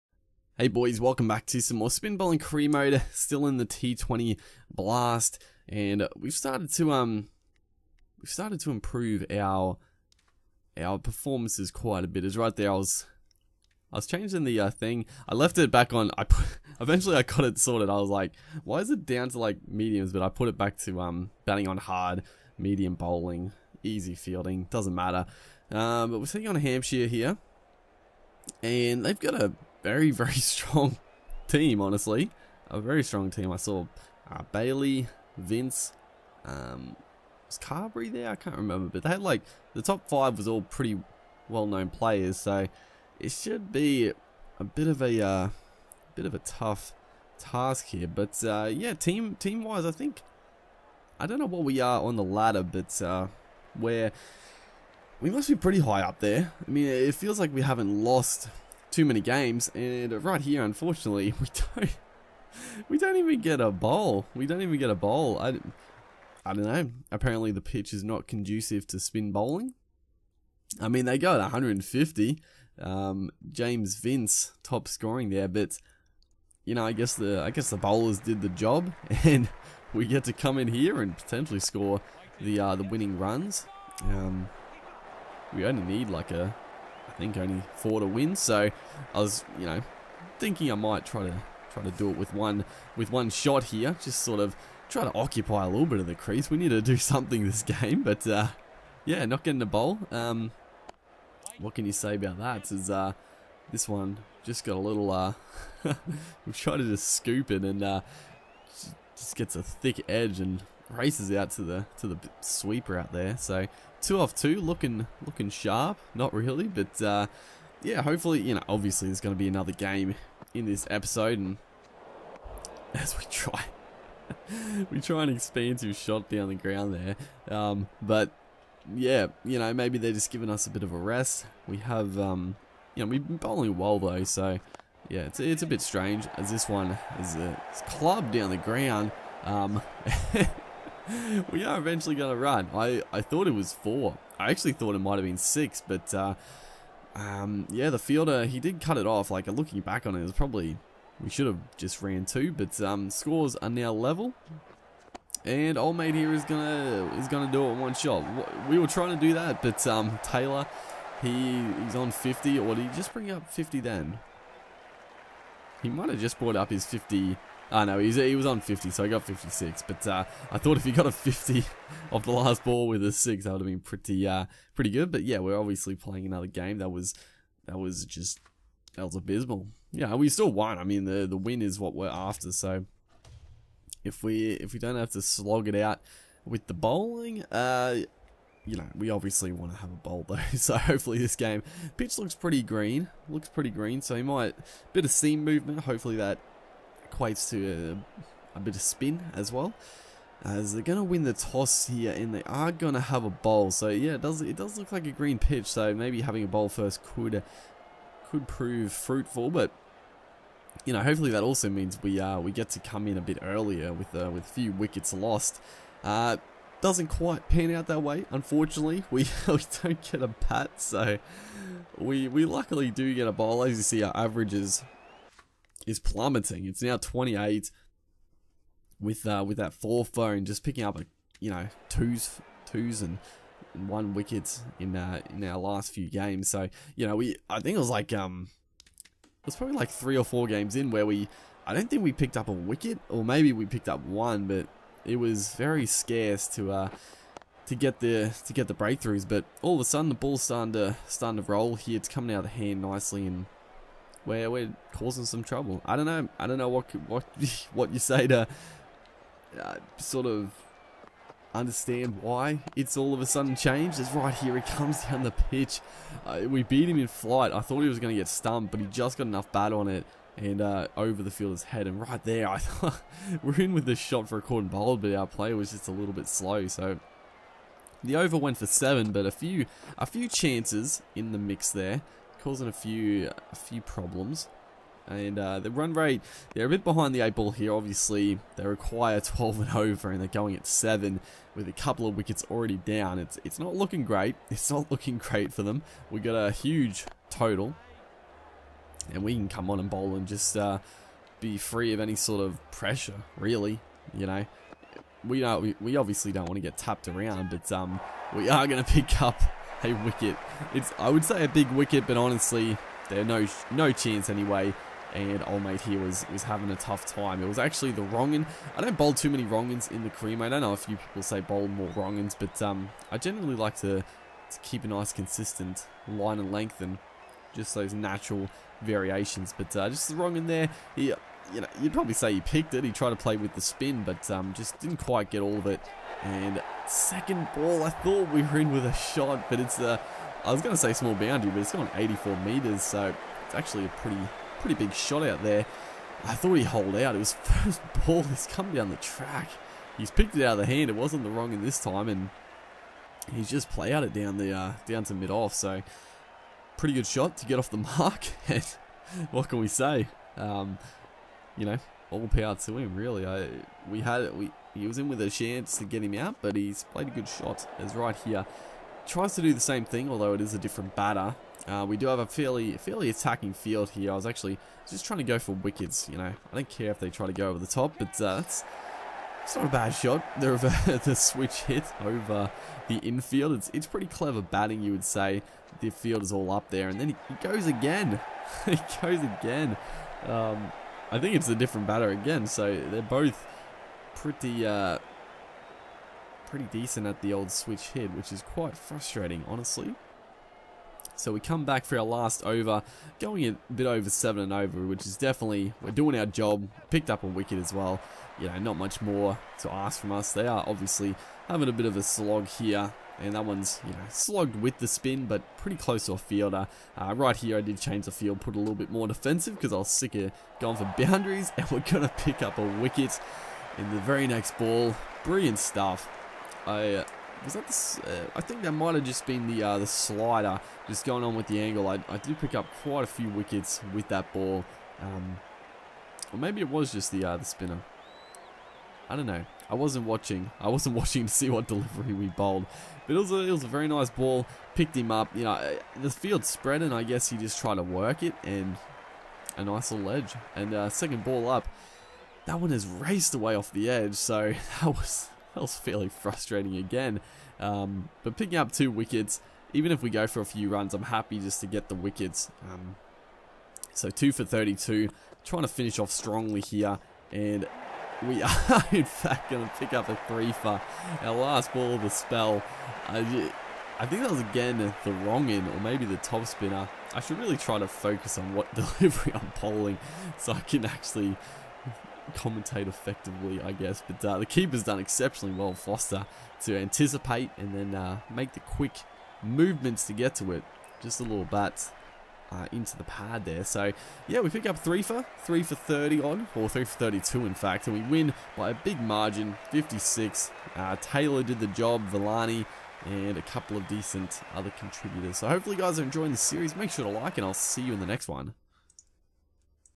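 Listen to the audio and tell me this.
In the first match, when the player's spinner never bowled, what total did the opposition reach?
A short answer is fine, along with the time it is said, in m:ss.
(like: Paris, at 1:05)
150, at 1:11.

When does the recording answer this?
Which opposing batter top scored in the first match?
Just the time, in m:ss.
1:13.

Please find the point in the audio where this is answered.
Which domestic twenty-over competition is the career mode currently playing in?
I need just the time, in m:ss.
0:03.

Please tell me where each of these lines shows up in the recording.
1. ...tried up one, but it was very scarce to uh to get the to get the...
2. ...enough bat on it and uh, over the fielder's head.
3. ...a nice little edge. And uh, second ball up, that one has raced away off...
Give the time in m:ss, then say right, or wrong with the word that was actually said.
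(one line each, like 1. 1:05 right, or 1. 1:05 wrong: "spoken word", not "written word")
1. 4:03 wrong: "picked", not "tried"
2. 4:29 right
3. 7:29 right.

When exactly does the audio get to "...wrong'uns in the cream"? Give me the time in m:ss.
5:19.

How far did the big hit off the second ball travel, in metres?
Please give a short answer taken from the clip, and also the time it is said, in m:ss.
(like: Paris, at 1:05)
84 metres, at 5:41.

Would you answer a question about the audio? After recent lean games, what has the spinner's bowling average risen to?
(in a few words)
28.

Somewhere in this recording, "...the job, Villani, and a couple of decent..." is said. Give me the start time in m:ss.
8:21.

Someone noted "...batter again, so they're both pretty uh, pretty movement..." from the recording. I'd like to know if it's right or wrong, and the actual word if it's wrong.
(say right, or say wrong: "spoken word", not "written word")
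wrong: "decent", not "movement".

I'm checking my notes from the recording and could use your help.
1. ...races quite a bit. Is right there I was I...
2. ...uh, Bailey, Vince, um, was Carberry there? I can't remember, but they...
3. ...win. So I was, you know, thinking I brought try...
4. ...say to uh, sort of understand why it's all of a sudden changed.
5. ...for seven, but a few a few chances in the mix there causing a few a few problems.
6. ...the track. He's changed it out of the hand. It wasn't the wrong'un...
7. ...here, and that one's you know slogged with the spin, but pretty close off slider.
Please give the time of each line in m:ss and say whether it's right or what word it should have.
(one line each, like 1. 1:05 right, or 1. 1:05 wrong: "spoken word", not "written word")
1. 0:10 wrong: "performances", not "races"
2. 0:34 right
3. 1:28 wrong: "might", not "brought"
4. 4:17 right
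5. 4:38 right
6. 5:48 wrong: "picked", not "changed"
7. 6:52 wrong: "fielder", not "slider".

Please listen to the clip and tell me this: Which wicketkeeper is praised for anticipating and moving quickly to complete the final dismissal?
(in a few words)
Foster.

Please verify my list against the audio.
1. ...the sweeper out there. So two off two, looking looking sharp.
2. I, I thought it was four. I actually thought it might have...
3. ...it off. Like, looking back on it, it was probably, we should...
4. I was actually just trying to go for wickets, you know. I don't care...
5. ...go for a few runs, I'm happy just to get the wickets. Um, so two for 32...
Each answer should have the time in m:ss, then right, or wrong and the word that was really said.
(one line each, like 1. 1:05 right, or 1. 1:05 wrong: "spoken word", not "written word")
1. 1:52 right
2. 2:22 right
3. 2:28 right
4. 6:14 right
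5. 7:40 right.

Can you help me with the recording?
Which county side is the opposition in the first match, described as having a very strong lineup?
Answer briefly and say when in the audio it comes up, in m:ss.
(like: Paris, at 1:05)
Hampshire, at 0:26.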